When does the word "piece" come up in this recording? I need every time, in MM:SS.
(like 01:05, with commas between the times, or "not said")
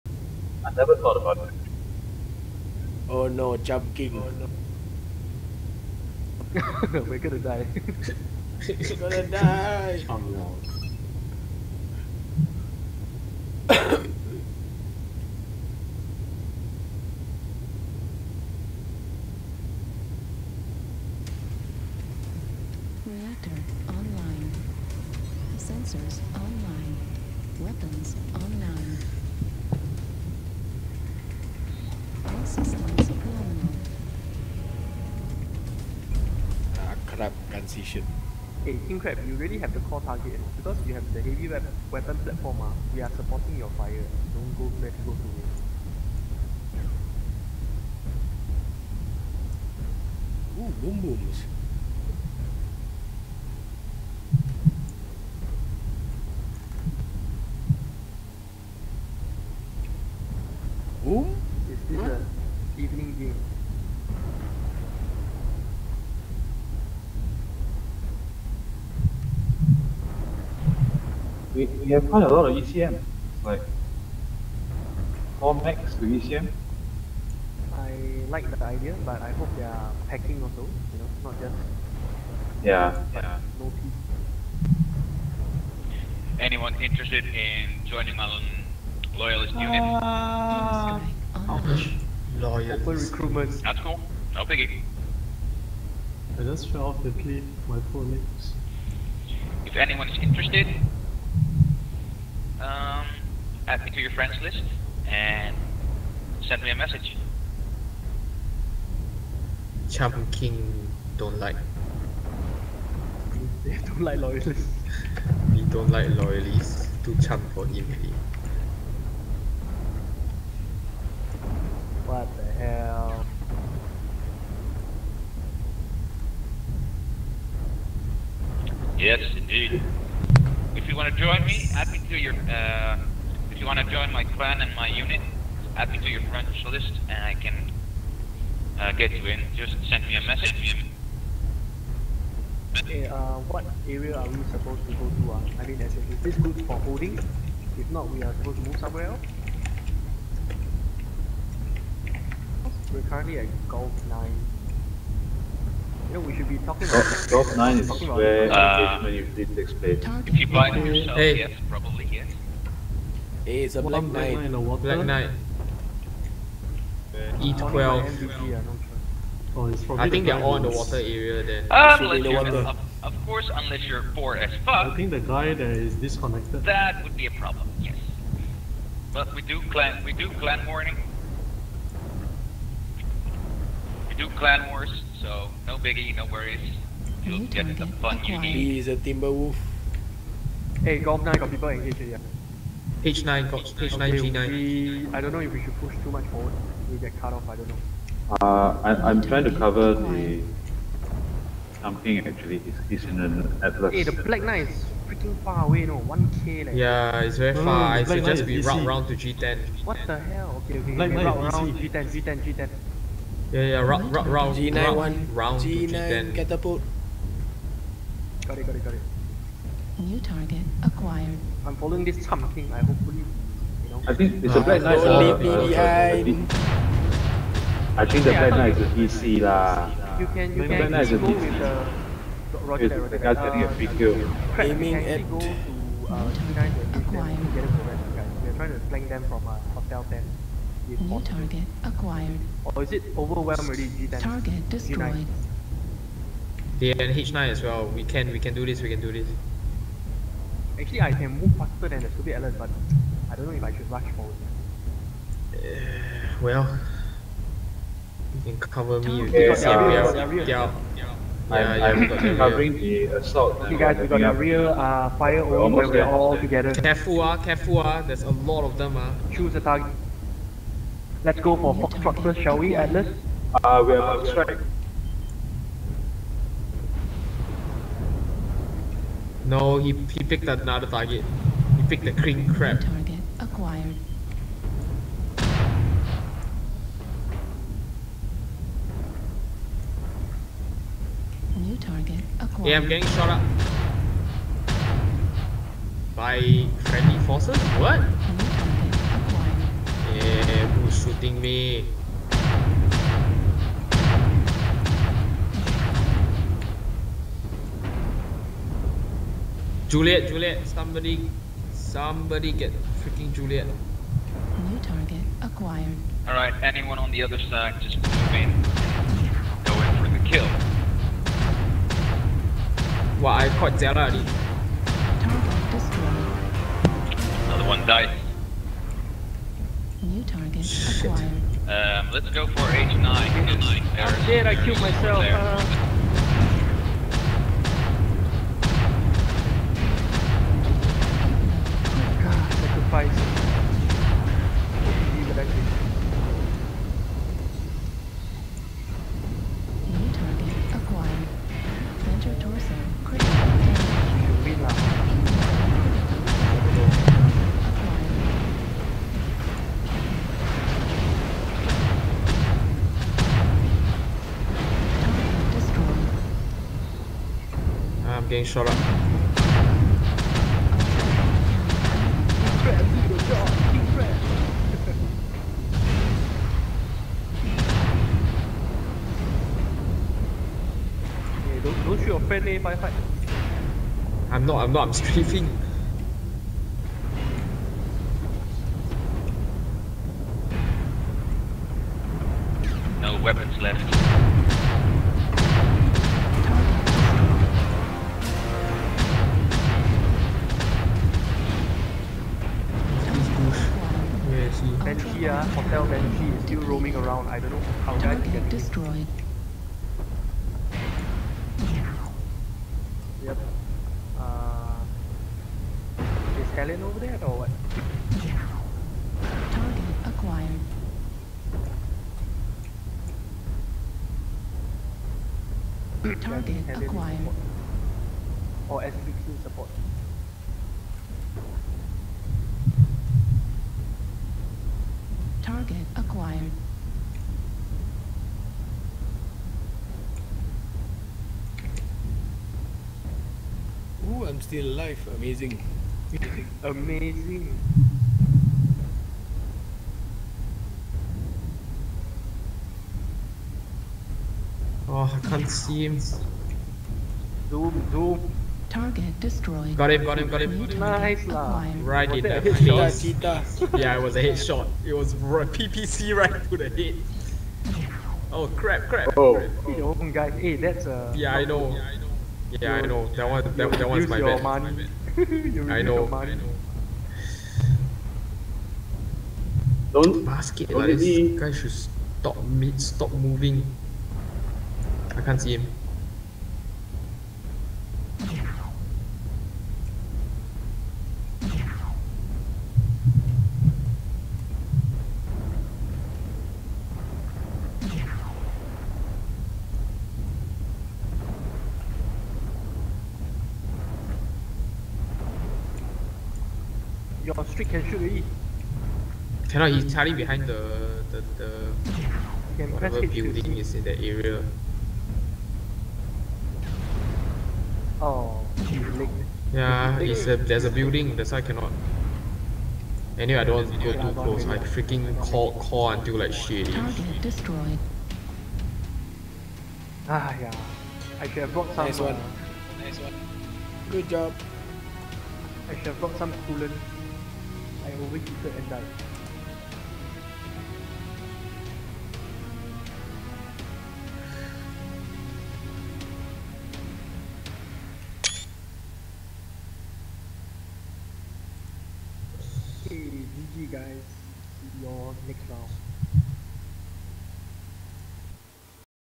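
01:23.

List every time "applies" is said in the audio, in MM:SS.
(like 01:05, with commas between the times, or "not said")
not said.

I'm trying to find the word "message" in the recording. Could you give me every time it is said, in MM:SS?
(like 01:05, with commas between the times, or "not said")
01:46, 02:20.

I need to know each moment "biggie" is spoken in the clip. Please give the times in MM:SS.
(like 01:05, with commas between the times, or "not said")
01:34, 03:05.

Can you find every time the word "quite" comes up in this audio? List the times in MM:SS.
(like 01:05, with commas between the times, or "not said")
01:12.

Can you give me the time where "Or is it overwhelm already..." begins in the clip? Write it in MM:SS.
04:02.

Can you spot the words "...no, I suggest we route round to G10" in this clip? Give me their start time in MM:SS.
03:28.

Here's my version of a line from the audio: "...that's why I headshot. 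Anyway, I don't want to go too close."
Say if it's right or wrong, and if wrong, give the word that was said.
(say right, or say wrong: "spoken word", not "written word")
wrong: "cannot", not "headshot".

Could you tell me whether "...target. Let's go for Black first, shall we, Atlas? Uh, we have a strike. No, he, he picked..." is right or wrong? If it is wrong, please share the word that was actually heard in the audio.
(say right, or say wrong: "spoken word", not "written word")
wrong: "Foxtrot", not "Black".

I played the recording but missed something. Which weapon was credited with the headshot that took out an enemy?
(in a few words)
PPC.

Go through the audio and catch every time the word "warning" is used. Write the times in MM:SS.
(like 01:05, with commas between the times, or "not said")
03:00.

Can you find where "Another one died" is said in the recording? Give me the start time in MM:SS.
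05:27.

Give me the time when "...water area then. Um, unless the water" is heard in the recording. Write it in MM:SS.
02:50.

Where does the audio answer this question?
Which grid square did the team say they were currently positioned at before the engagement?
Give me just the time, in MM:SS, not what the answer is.
02:33.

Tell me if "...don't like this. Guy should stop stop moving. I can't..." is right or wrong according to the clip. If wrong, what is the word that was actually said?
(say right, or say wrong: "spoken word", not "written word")
right.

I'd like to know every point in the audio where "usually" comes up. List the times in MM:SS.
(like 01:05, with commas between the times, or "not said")
02:39.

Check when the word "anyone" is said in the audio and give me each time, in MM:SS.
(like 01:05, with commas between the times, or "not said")
01:26, 01:39, 05:16.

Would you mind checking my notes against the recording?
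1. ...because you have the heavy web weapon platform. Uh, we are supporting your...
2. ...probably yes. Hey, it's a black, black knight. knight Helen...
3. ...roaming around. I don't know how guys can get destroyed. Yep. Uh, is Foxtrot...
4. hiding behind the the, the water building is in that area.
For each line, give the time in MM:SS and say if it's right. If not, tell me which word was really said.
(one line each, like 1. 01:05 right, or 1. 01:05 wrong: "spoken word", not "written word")
1. 00:40 right
2. 02:41 wrong: "Black", not "Helen"
3. 06:46 wrong: "Helen", not "Foxtrot"
4. 08:29 wrong: "whatever", not "water".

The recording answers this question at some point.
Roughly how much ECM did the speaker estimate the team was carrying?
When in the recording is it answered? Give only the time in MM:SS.
01:15.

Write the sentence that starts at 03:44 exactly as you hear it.
I think it's uh, a black knight.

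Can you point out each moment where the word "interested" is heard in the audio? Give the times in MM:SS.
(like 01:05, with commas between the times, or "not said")
01:26, 01:40.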